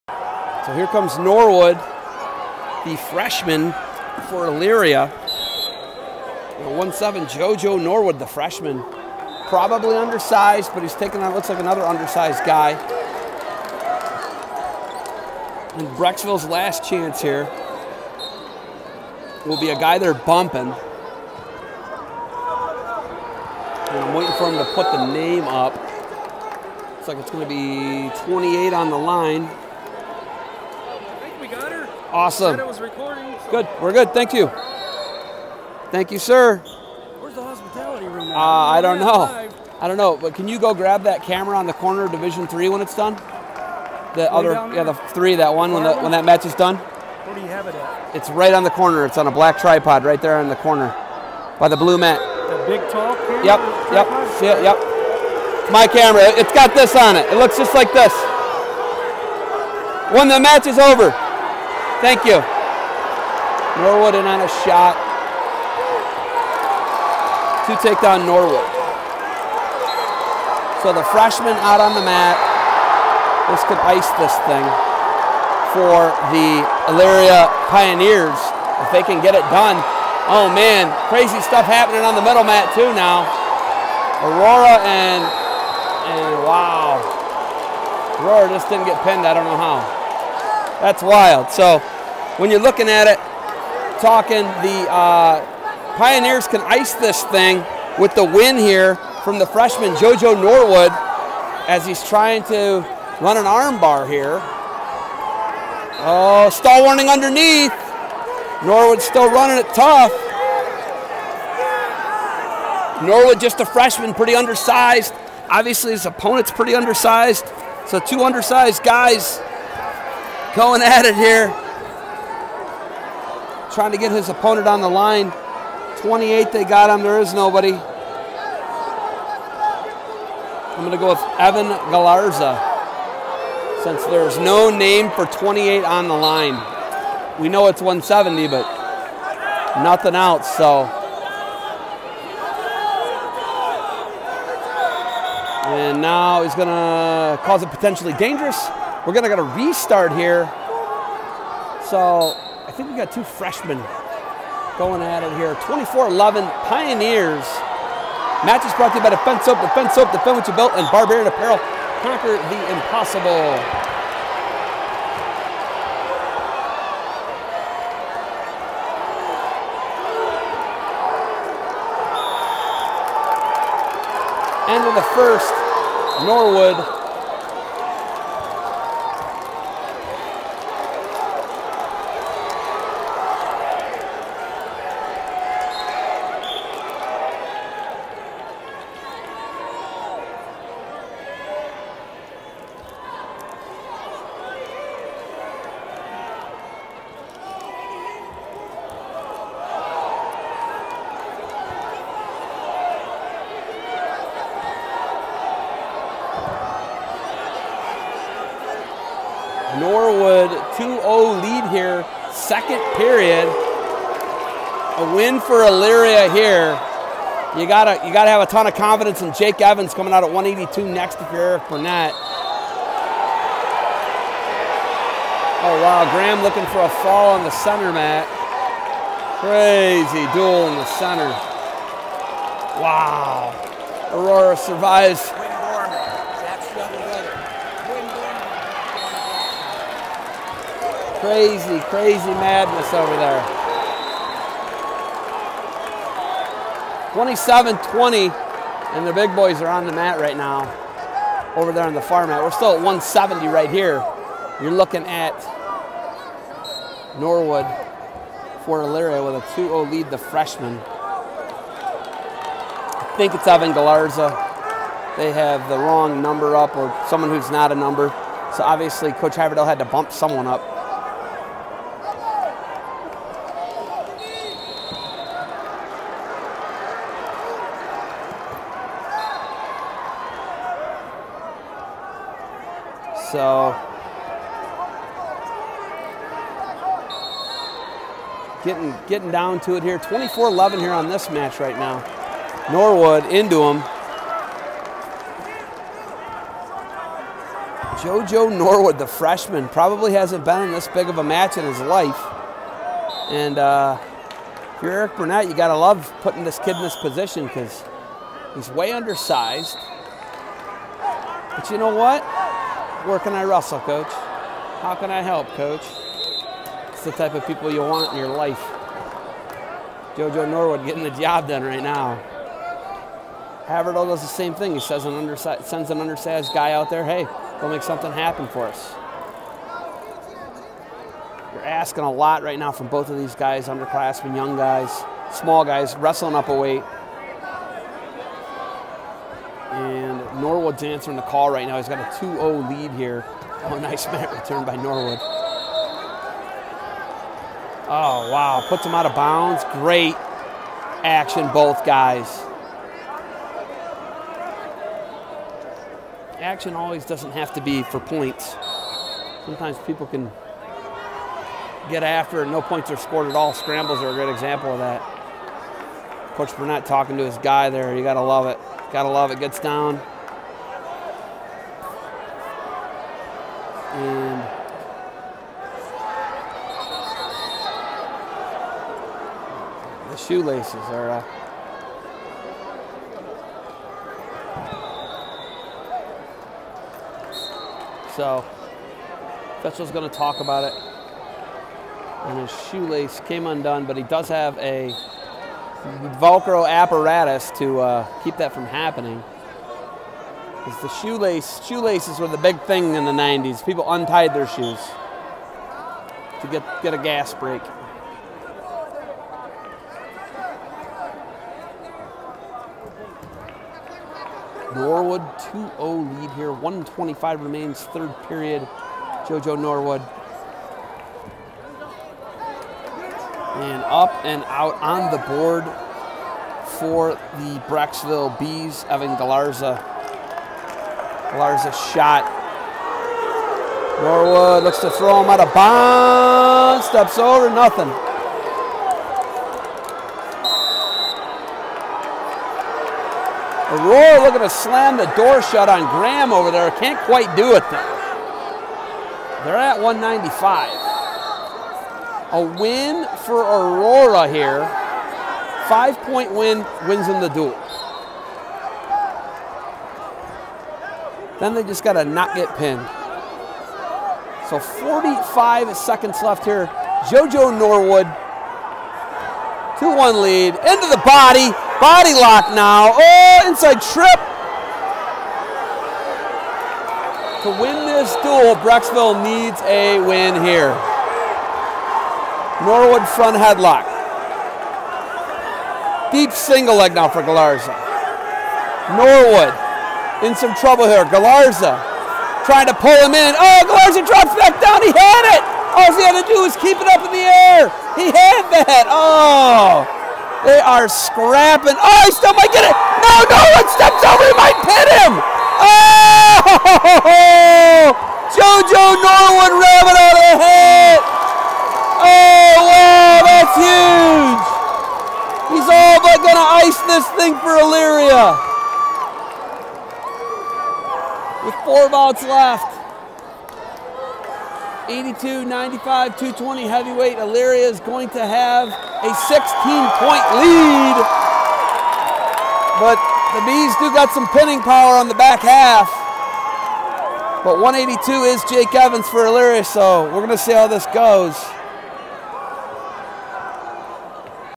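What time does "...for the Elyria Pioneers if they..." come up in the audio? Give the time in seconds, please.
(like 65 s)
75 s.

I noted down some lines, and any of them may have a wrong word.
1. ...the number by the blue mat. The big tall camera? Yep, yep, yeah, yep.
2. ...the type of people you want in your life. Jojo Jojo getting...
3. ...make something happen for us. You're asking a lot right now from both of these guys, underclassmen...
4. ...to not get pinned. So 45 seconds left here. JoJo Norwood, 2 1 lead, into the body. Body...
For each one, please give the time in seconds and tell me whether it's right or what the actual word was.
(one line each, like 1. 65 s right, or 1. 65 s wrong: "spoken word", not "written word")
1. 50 s wrong: "corner", not "number"
2. 317 s wrong: "Norwood", not "Jojo"
3. 327 s right
4. 461 s right.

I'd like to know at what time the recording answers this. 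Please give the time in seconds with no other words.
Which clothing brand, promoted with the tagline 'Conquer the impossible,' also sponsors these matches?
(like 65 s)
160 s.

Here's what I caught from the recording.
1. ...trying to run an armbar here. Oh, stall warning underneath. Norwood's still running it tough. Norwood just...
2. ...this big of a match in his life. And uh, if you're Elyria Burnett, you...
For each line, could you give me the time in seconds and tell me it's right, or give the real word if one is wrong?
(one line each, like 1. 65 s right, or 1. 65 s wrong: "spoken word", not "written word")
1. 102 s right
2. 300 s wrong: "Eric", not "Elyria".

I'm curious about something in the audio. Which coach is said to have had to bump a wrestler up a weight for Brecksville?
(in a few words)
Coach Haverdill.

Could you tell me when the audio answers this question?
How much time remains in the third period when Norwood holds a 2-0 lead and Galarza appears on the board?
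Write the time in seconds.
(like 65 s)
416 s.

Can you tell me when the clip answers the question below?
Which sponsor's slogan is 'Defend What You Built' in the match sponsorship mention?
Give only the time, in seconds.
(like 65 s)
159 s.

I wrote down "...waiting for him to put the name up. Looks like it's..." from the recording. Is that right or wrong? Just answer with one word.
right.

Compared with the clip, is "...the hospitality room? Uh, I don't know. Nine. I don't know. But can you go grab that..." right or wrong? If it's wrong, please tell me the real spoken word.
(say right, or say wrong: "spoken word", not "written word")
wrong: "Five", not "Nine".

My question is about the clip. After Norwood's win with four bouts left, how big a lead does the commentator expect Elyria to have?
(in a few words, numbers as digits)
16.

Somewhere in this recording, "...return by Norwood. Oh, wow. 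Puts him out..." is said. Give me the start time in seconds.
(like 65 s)
344 s.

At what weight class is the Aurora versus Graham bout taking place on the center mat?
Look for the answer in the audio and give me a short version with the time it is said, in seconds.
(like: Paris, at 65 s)
195, at 449 s.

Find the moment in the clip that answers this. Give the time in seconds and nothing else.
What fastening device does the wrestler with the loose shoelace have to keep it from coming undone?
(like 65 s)
396 s.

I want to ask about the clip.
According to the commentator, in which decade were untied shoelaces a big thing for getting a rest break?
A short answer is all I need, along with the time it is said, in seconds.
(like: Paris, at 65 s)
the 90s, at 403 s.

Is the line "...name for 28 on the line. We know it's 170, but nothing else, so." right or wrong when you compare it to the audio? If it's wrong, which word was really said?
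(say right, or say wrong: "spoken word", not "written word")
right.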